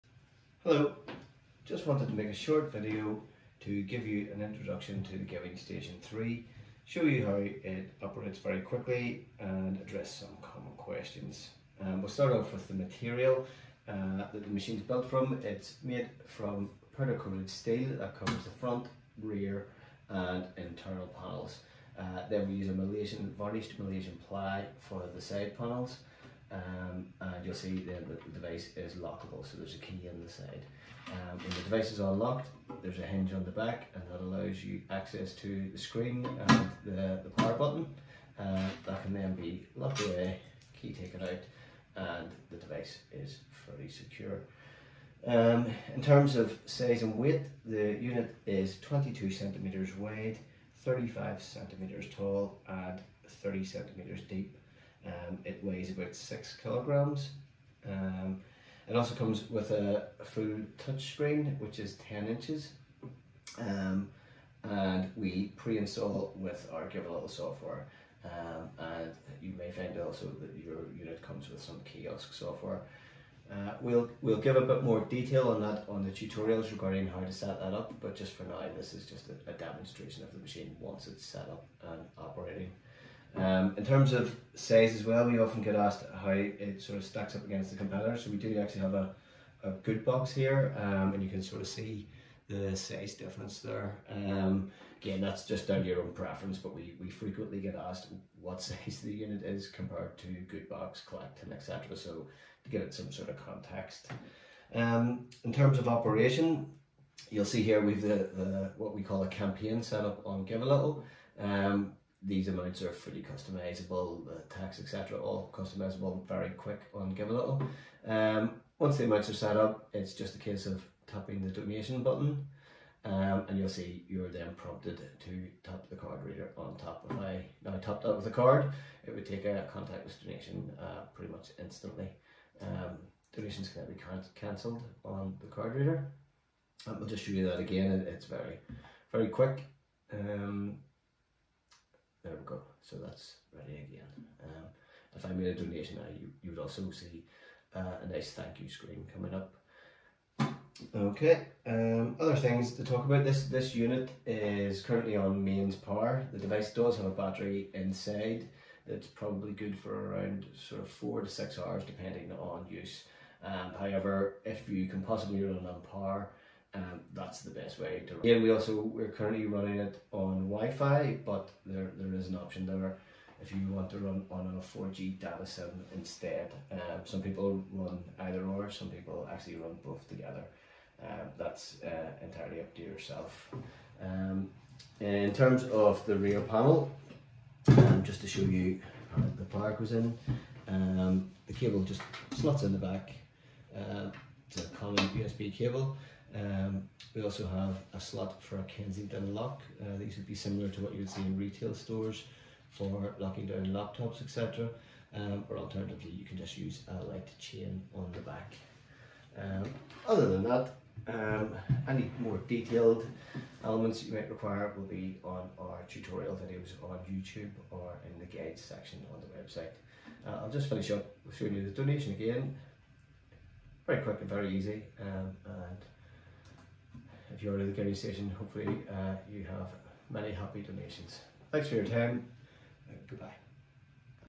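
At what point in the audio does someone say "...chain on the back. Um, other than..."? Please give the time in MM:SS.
03:27.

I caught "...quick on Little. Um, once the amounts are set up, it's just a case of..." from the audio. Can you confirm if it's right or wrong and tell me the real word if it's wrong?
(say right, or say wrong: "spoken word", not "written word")
right.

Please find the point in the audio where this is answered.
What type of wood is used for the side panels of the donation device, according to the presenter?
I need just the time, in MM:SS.
00:23.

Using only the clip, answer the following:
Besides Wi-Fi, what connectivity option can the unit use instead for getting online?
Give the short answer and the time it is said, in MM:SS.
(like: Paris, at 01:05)
4G data sim, at 02:54.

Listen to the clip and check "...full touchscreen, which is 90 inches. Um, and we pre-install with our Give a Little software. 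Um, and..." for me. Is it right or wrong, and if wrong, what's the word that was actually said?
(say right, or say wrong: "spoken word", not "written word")
wrong: "10", not "90".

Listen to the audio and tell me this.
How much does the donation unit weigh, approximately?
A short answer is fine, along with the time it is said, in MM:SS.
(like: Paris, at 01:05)
6 kilograms, at 00:56.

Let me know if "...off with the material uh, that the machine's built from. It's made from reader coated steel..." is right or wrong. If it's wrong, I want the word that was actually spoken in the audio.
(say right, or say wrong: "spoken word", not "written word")
wrong: "powder", not "reader".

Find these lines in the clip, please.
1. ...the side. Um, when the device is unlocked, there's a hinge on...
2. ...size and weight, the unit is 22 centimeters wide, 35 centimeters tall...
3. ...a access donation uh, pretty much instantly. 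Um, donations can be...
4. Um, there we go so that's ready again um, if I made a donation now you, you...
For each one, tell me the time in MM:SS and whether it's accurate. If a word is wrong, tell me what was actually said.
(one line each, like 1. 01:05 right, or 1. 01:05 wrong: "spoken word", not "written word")
1. 00:30 right
2. 00:46 right
3. 02:09 wrong: "contactless", not "access"
4. 02:20 right.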